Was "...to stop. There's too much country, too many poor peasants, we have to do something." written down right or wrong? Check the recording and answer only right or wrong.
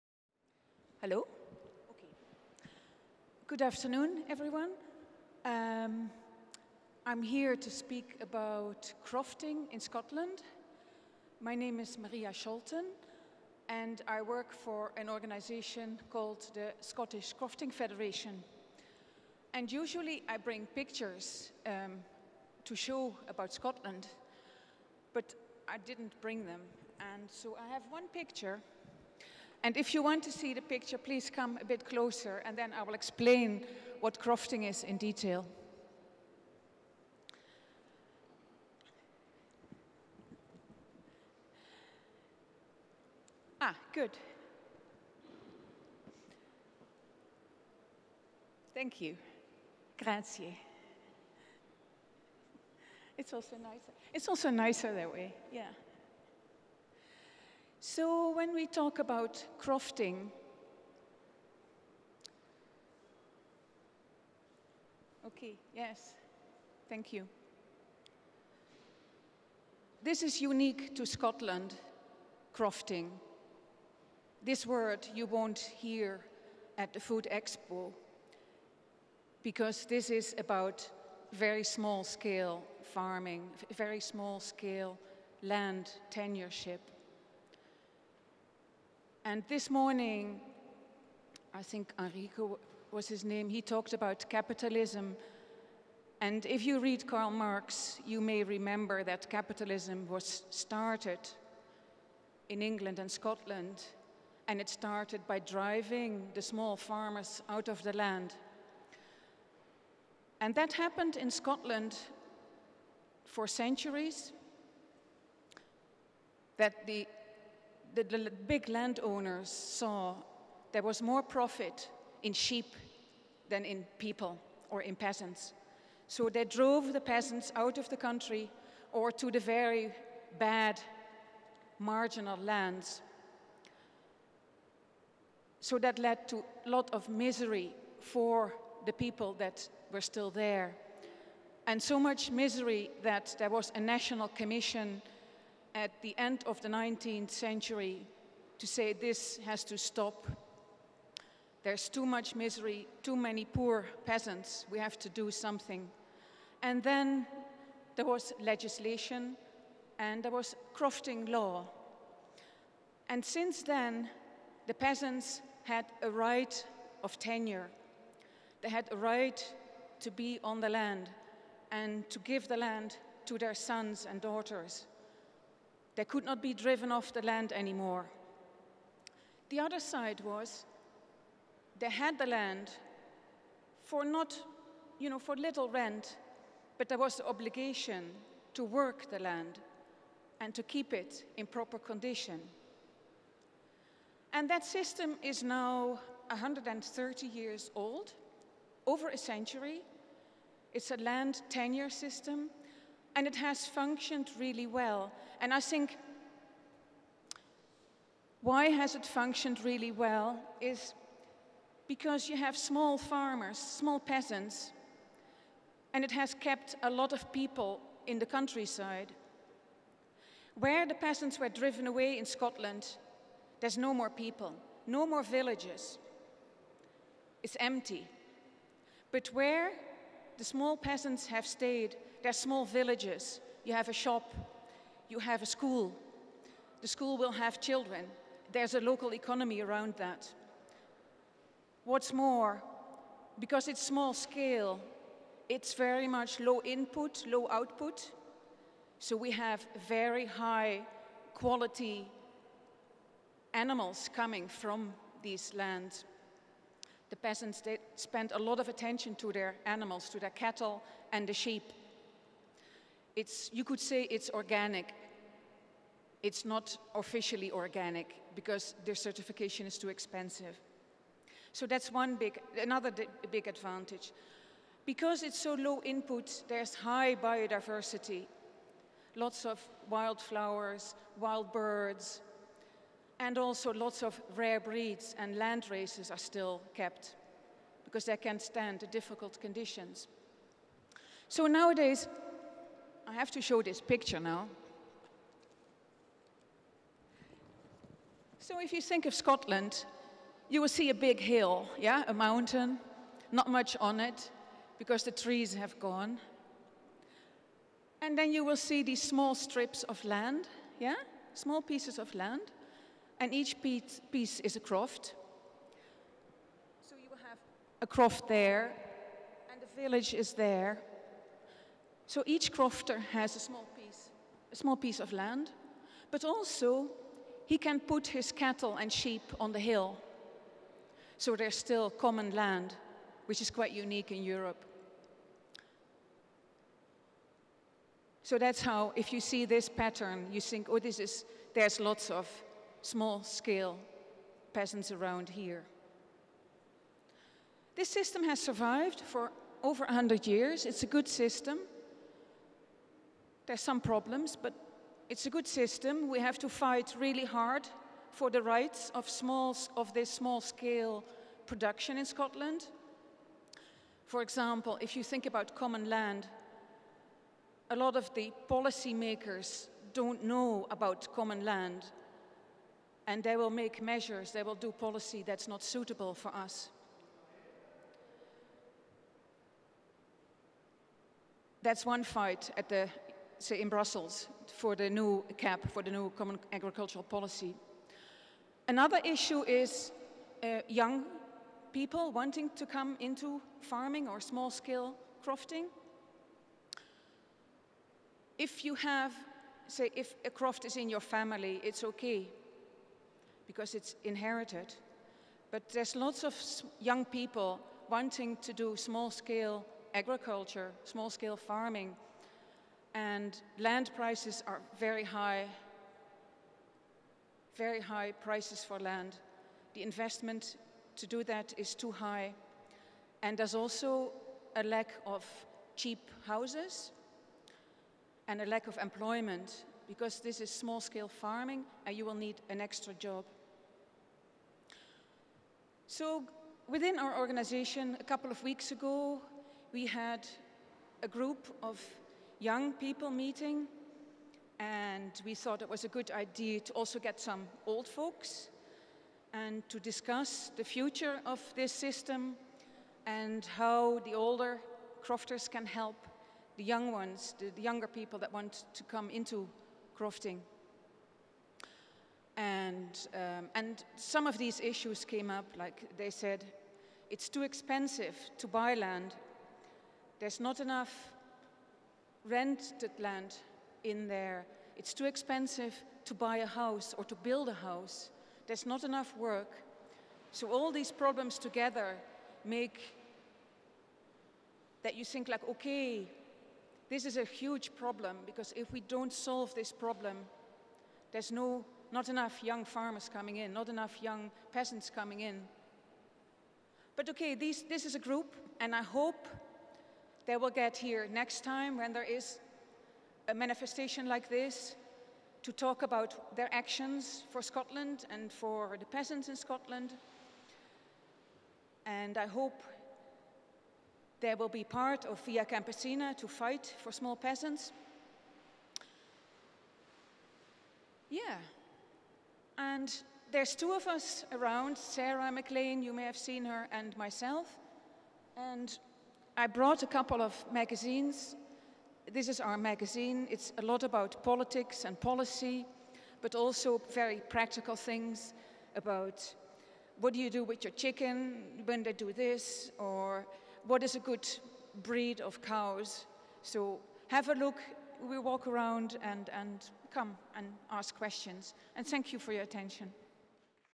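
wrong.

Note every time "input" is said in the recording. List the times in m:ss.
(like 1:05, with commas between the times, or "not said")
4:06, 4:35.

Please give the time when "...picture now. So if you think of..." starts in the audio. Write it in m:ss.
4:53.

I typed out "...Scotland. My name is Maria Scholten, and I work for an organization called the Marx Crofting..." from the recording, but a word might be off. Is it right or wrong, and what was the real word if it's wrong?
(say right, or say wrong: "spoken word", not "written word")
wrong: "Scottish", not "Marx".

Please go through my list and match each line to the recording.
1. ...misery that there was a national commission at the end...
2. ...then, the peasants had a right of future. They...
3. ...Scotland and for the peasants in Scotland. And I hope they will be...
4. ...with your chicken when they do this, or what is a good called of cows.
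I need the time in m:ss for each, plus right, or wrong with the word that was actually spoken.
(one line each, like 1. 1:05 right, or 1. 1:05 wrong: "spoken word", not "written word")
1. 2:22 right
2. 2:43 wrong: "tenure", not "future"
3. 8:27 right
4. 9:00 wrong: "breed", not "called".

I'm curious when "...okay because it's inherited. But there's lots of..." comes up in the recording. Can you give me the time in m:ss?
6:41.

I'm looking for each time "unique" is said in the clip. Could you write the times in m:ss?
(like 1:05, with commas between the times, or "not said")
1:10, 5:33.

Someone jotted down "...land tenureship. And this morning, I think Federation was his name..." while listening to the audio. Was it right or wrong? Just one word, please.
wrong.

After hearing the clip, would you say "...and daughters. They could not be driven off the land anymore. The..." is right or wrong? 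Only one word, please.
right.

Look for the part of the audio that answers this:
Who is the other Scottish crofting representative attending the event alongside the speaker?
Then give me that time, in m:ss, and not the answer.
8:44.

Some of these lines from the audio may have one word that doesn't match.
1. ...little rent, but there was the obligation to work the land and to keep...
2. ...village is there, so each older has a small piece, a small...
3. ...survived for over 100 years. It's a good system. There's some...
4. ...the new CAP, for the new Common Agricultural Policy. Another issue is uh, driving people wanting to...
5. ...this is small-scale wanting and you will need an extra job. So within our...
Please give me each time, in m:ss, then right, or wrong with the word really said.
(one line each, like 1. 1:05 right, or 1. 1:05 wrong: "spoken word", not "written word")
1. 3:05 right
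2. 5:19 wrong: "crofter", not "older"
3. 5:48 right
4. 6:24 wrong: "young", not "driving"
5. 7:10 wrong: "farming", not "wanting".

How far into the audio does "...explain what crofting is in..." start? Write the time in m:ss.
0:32.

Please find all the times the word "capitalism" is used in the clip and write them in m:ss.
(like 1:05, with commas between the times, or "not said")
1:34, 1:39.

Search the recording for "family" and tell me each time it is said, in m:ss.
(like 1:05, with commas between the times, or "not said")
6:41.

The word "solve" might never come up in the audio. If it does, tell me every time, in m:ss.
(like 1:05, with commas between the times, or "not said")
8:09.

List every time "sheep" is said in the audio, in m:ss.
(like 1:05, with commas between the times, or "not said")
2:02, 4:21, 5:28.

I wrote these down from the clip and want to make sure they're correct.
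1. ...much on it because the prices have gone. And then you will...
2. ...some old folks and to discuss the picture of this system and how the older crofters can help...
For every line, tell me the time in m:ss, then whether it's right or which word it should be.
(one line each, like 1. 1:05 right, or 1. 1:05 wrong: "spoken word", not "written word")
1. 5:03 wrong: "trees", not "prices"
2. 7:27 wrong: "future", not "picture".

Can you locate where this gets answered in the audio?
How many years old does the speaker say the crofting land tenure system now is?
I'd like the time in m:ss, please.
3:16.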